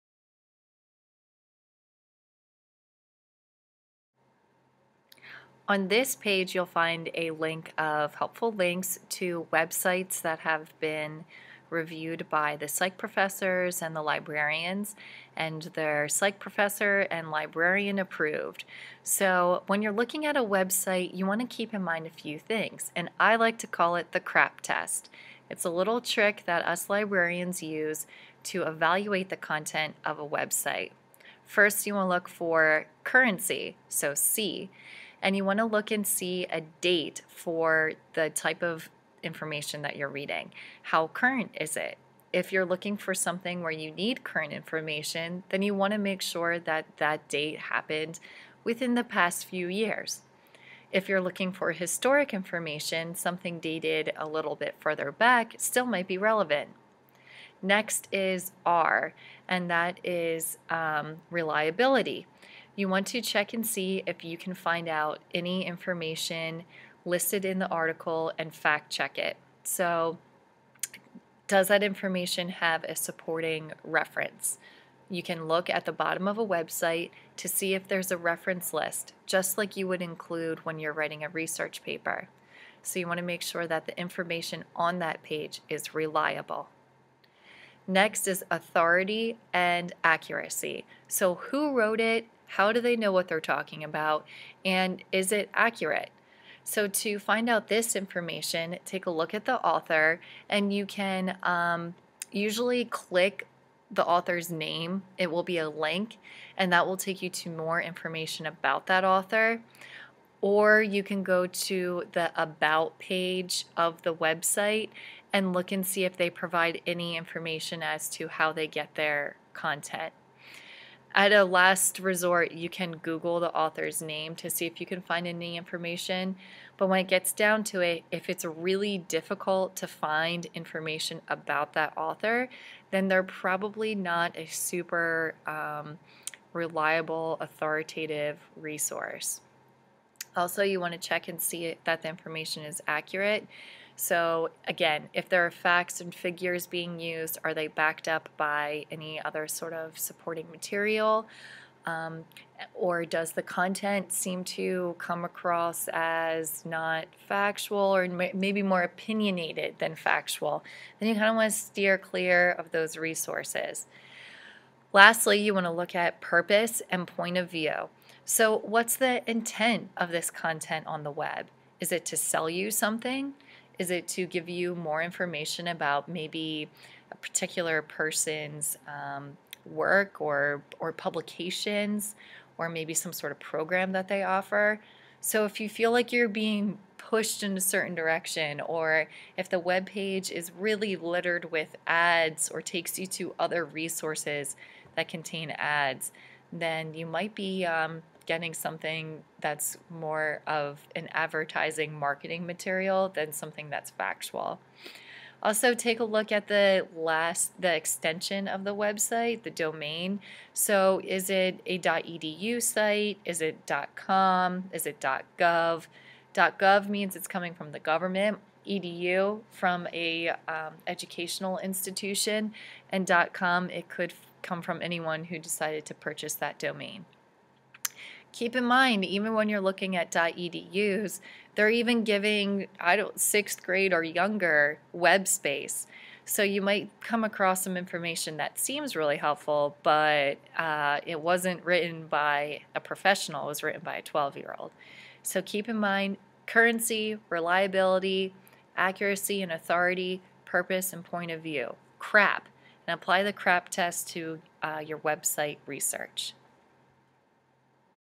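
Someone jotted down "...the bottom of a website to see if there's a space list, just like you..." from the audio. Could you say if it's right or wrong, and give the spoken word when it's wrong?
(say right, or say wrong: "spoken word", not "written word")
wrong: "reference", not "space".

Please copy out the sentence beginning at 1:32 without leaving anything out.
How do they know what they're talking about?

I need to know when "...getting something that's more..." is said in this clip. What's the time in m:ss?
3:18.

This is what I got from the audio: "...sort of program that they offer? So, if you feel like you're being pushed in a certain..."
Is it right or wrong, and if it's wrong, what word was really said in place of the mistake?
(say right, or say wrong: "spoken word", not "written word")
right.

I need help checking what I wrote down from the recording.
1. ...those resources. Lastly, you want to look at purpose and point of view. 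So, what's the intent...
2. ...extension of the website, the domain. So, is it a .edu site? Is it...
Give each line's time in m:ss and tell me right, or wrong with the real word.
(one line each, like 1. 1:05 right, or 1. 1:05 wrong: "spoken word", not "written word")
1. 2:42 right
2. 3:27 right.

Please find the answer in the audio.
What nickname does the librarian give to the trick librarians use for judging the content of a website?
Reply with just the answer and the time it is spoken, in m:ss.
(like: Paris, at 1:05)
the crap test, at 0:24.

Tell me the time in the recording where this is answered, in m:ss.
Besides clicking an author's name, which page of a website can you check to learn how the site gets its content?
1:52.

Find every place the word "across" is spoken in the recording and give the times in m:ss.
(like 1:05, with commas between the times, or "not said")
2:35, 3:57.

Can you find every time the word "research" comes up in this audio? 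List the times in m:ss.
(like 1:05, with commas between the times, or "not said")
1:21, 4:15.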